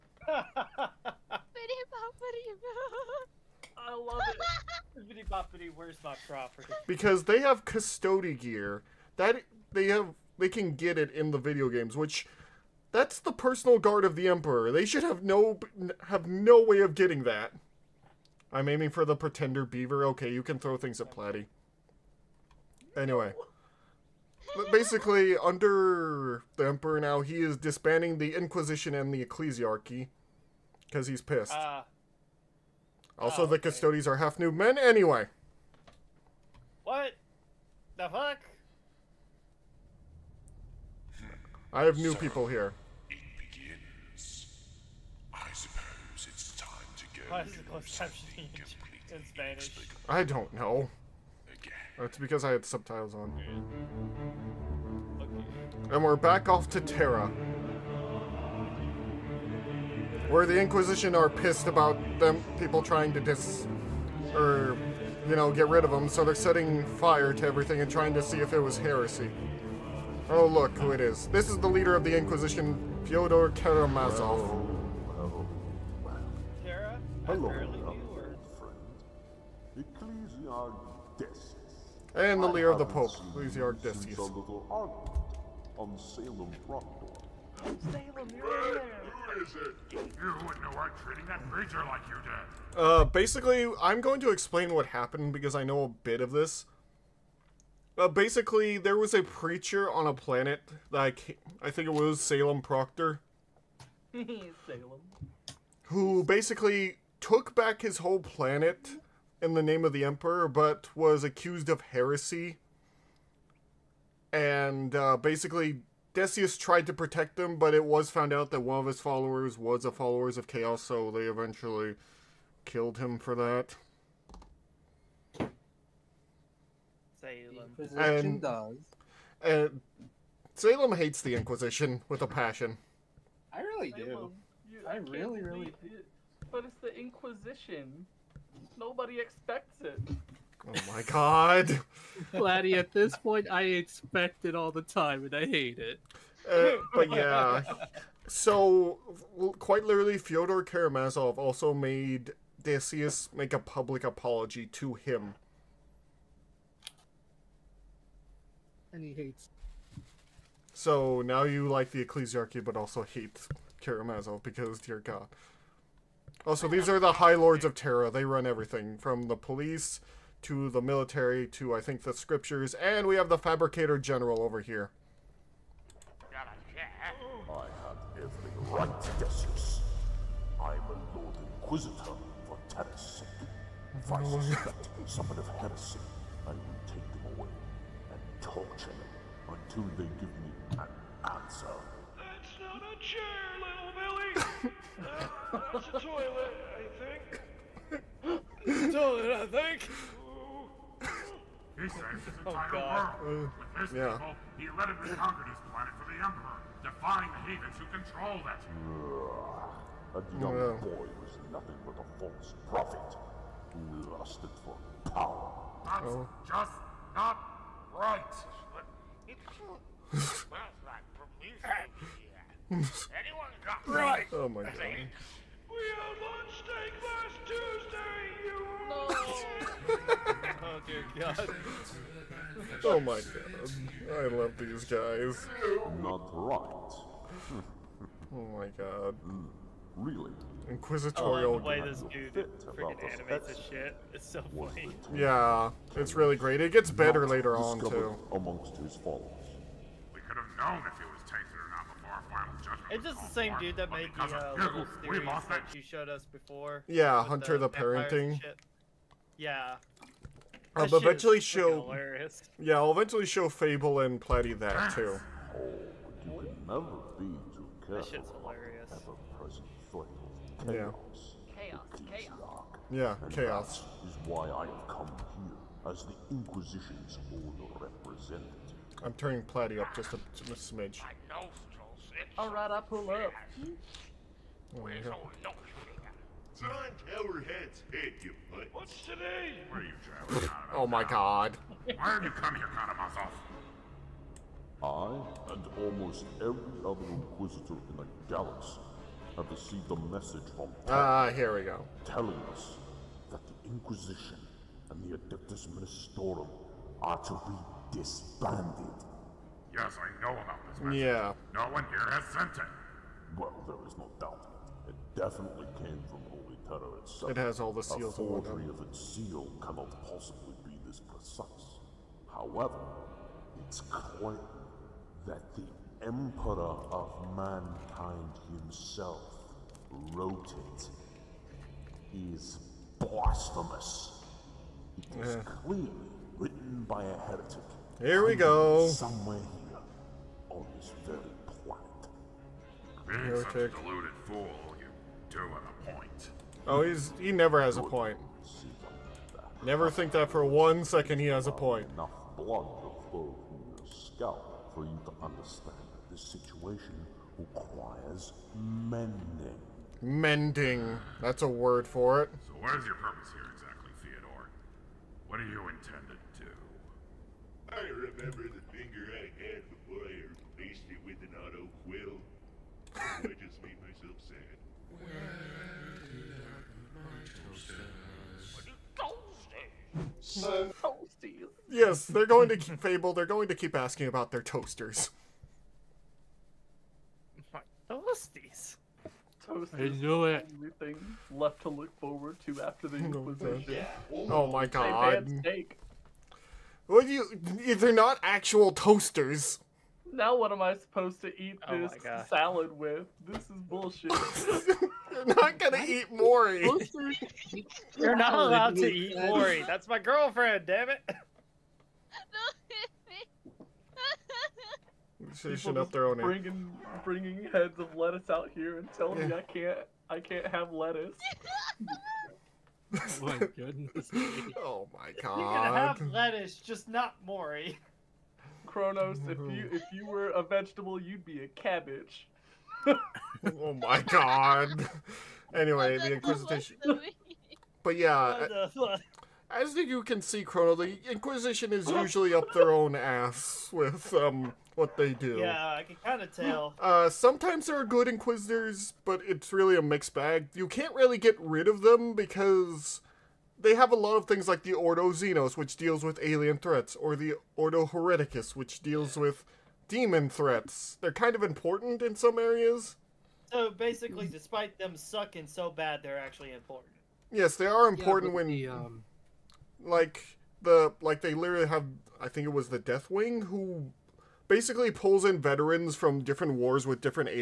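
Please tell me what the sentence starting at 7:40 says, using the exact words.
They're kind of important in some areas.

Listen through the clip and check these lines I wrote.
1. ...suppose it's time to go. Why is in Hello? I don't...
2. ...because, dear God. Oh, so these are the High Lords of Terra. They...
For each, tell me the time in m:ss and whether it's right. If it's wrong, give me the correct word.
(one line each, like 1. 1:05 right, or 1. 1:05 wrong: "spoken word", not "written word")
1. 0:45 wrong: "Spanish", not "Hello"
2. 2:44 right.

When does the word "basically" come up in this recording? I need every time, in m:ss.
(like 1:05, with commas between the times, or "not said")
0:24, 1:33, 1:38, 1:46, 1:55, 7:43, 7:54.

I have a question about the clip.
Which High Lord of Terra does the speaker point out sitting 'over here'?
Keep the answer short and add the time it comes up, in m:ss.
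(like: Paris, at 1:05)
Fabricator General, at 2:53.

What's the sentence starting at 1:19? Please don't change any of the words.
Ecclesiarch and the Lear of the Pope, Lucy Archdesius.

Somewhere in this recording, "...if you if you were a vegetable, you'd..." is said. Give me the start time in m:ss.
7:09.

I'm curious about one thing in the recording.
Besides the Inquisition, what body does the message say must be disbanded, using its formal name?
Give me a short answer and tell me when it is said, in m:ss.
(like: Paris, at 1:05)
Adeptus Ministorum, at 5:05.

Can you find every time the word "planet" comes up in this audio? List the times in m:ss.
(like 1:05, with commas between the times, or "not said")
1:40, 1:48, 3:25.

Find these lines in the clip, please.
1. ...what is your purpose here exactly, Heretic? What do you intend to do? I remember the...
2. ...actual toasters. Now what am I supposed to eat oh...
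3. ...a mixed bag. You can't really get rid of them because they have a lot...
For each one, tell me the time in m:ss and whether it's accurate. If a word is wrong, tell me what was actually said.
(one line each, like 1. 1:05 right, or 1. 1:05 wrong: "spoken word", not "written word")
1. 6:02 wrong: "Theodore", not "Heretic"
2. 6:38 right
3. 7:29 right.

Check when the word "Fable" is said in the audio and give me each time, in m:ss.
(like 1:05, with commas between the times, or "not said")
4:23, 6:22.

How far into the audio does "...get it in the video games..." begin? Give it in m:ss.
0:10.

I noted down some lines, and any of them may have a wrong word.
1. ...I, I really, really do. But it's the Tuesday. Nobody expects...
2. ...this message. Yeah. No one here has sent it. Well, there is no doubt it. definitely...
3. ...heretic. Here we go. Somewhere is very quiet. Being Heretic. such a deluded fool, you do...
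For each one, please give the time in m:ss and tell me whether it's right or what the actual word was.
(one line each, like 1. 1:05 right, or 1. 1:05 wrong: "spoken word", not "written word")
1. 2:14 wrong: "Inquisition", not "Tuesday"
2. 5:10 right
3. 5:37 right.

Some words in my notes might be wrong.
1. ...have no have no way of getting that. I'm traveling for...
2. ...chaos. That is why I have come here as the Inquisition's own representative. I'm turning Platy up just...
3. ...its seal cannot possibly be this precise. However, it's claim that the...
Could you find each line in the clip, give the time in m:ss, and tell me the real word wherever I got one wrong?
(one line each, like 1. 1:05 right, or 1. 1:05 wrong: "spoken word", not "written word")
1. 0:15 wrong: "aiming", not "traveling"
2. 4:33 right
3. 5:18 right.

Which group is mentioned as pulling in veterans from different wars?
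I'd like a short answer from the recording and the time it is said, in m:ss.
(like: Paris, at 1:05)
Deathwing, at 7:52.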